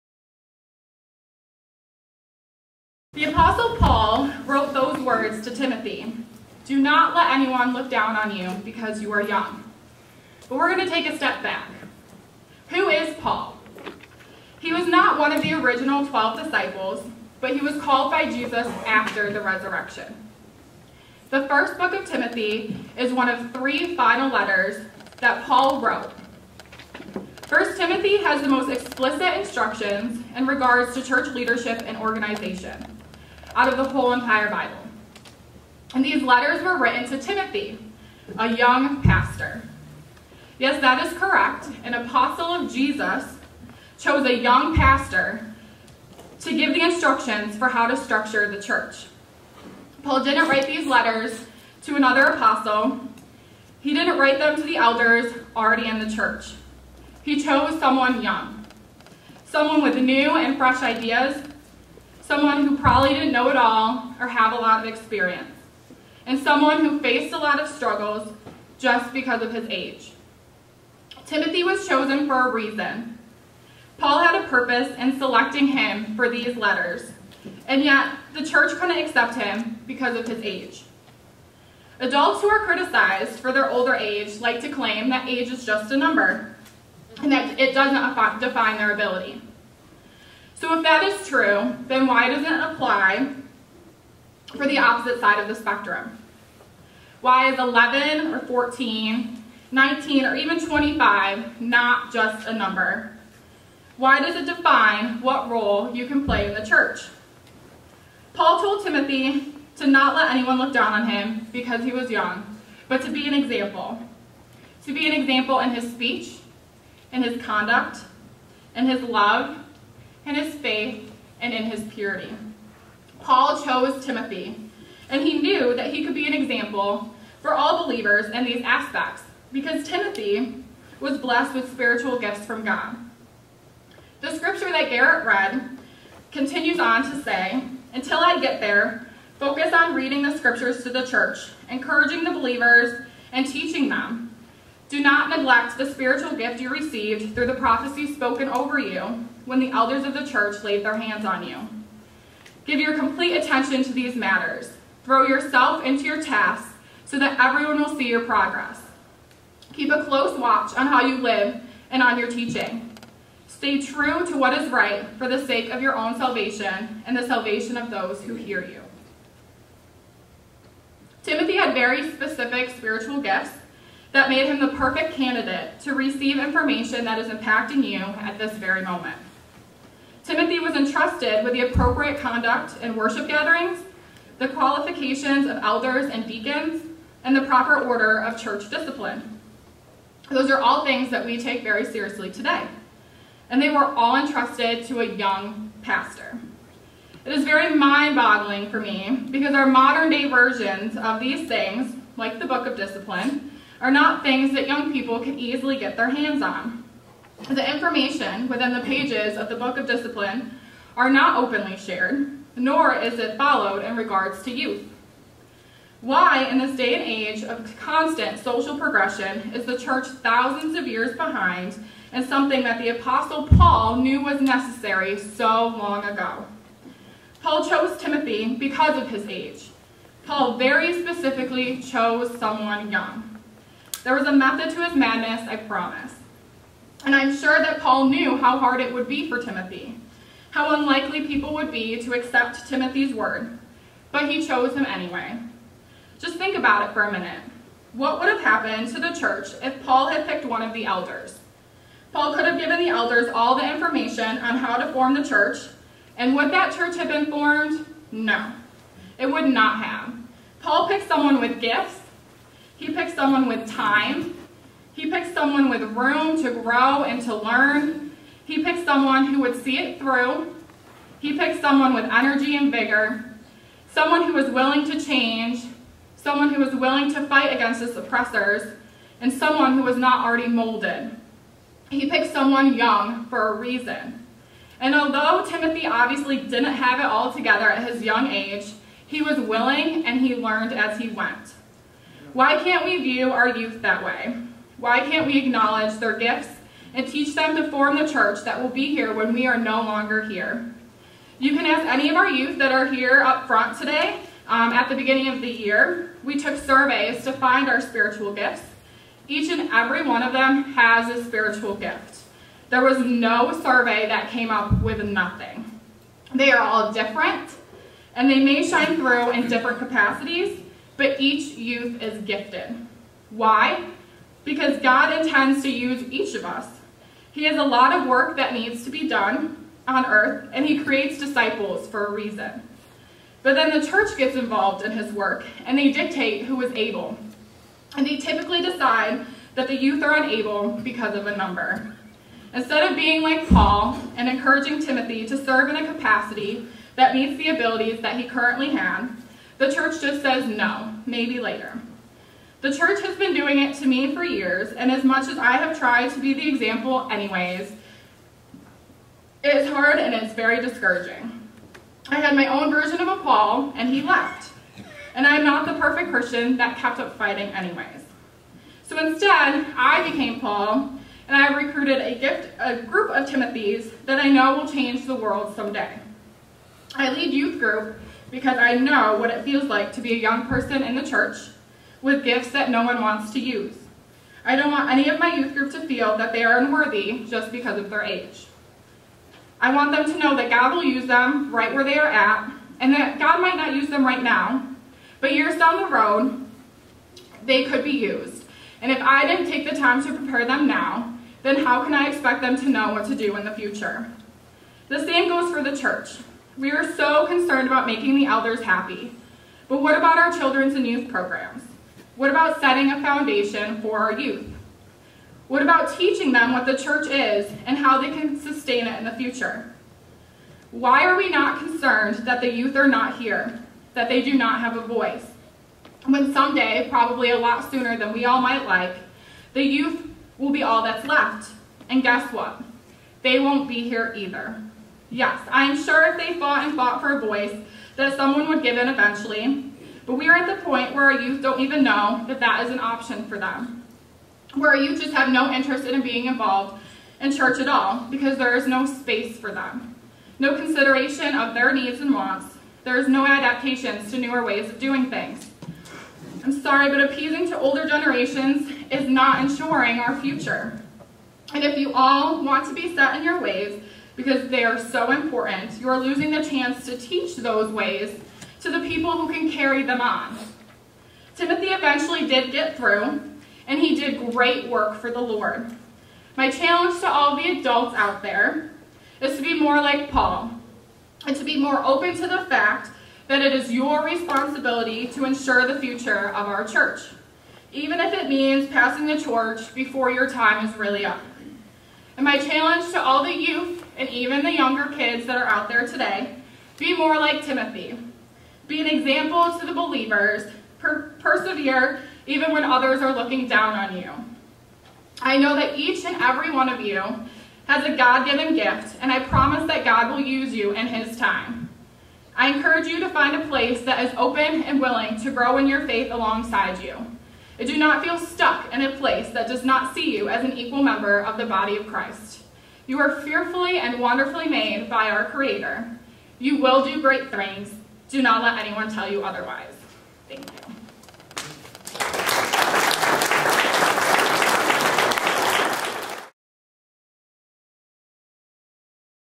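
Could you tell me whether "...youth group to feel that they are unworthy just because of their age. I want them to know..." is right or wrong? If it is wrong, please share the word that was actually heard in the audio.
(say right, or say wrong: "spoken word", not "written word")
right.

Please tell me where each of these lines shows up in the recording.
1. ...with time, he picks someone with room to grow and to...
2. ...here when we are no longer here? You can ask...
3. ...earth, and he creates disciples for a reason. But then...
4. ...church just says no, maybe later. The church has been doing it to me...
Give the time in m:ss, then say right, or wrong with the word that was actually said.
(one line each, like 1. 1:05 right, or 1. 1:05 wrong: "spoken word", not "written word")
1. 4:23 right
2. 4:58 right
3. 5:30 right
4. 5:49 right.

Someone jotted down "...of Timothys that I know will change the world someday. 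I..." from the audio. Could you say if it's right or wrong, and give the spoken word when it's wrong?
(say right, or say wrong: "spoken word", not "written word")
right.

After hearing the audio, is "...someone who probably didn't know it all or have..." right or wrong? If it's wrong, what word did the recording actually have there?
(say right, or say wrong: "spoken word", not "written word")
right.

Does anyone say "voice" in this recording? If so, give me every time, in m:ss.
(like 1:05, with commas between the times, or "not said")
7:04, 7:17.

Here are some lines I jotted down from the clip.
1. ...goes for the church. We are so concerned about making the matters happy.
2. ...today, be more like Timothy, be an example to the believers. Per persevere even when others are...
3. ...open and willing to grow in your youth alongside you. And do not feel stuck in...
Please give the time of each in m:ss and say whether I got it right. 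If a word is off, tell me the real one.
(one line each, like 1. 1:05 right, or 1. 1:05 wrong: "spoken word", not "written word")
1. 6:45 wrong: "elders", not "matters"
2. 8:15 right
3. 8:34 wrong: "faith", not "youth".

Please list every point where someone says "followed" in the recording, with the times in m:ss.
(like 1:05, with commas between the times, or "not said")
3:33.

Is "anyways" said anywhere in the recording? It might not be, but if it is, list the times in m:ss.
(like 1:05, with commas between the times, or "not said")
4:04, 5:57, 6:07.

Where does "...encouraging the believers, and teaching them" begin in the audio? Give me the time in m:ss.
2:21.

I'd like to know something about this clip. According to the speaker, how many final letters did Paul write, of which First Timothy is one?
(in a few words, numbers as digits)
3.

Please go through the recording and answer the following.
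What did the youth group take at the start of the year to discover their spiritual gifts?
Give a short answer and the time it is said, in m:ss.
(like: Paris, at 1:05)
Surveys, at 5:06.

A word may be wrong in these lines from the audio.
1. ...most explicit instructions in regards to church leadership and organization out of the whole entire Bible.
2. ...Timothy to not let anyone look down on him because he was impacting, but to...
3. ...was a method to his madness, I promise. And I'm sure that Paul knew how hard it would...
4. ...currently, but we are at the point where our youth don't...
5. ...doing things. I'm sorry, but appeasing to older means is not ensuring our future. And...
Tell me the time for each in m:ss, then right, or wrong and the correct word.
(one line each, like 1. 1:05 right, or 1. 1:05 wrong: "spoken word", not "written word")
1. 0:28 right
2. 1:48 wrong: "young", not "impacting"
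3. 3:54 right
4. 7:18 wrong: "eventually", not "currently"
5. 7:34 wrong: "generations", not "means".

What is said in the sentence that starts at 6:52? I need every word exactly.
What about setting a foundation for our youth?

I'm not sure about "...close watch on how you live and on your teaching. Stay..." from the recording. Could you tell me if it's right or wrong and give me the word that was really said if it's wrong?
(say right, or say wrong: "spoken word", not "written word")
right.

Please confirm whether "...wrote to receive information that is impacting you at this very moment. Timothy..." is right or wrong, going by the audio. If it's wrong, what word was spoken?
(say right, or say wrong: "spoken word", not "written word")
wrong: "candidate", not "wrote".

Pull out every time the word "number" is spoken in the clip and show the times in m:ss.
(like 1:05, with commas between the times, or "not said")
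1:25, 1:42, 5:41.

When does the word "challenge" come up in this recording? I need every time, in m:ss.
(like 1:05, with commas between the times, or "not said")
7:56, 8:12.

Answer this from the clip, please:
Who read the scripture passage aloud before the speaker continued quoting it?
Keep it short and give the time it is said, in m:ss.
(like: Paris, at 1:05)
Garrett, at 2:14.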